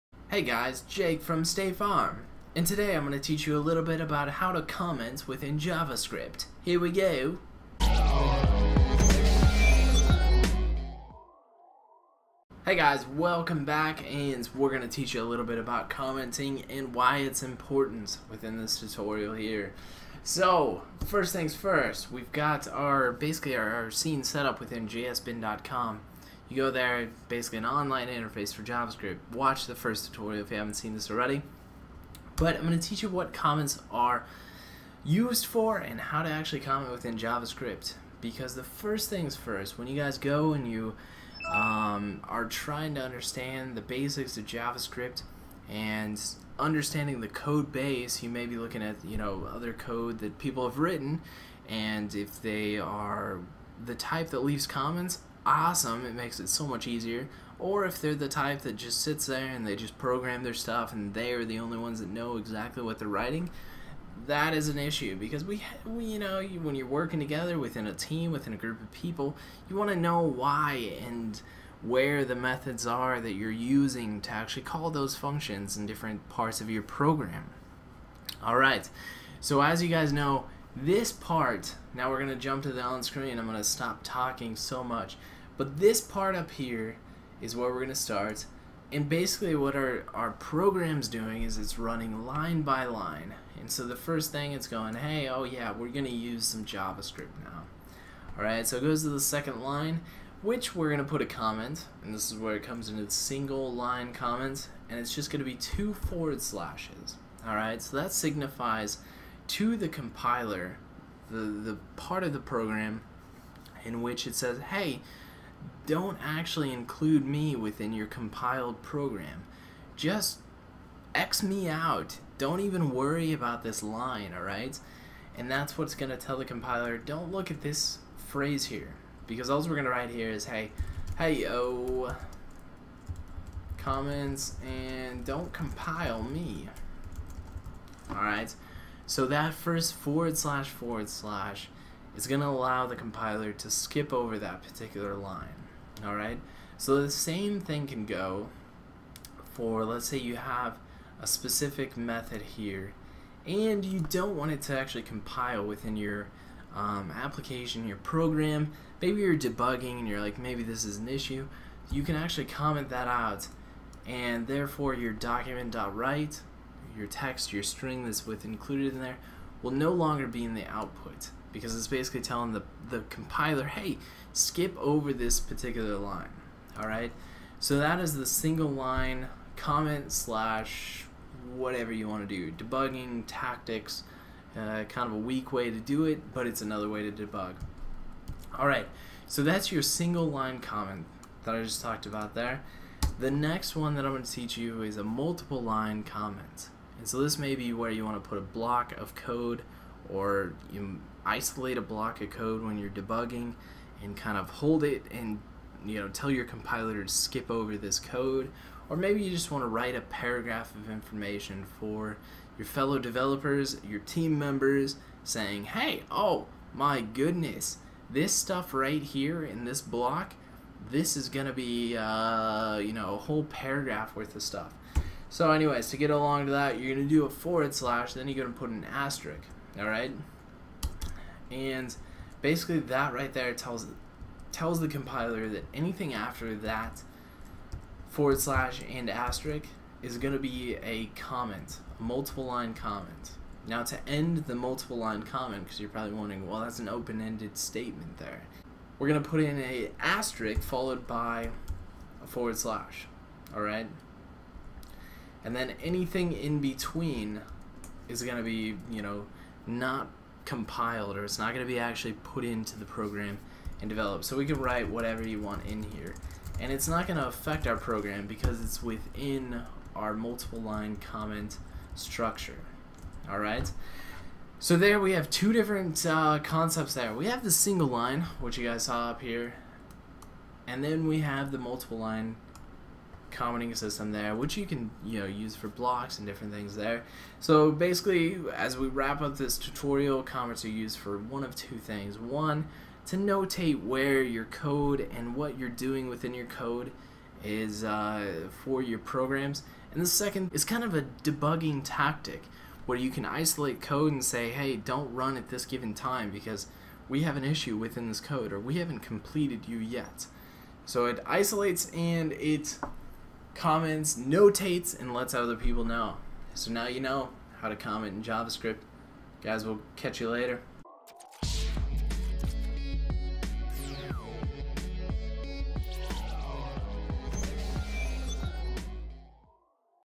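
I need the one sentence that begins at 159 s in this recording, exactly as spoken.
Maybe you're debugging and you're like, maybe this is an issue.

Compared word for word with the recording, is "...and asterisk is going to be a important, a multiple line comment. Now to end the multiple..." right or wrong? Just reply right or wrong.
wrong.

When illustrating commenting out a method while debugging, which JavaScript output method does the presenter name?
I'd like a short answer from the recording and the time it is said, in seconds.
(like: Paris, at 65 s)
document.write, at 165 s.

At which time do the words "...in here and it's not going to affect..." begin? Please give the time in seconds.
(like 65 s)
265 s.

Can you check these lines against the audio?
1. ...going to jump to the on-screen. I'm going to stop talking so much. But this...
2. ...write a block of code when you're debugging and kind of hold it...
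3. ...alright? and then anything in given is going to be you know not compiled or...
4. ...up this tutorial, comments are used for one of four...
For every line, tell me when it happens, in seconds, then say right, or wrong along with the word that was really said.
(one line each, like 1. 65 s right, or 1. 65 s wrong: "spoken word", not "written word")
1. 82 s right
2. 201 s wrong: "isolate", not "write"
3. 253 s wrong: "between", not "given"
4. 289 s wrong: "two", not "four".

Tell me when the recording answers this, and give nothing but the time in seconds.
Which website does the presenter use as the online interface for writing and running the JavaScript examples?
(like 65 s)
24 s.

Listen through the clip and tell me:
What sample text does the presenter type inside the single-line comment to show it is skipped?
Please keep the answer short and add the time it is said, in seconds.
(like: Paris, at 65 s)
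hey, oh, comments, and don't compile me, at 131 s.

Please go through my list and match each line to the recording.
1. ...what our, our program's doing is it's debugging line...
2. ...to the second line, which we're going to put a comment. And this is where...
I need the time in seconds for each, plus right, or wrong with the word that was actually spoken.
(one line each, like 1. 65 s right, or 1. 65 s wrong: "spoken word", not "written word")
1. 89 s wrong: "running", not "debugging"
2. 99 s right.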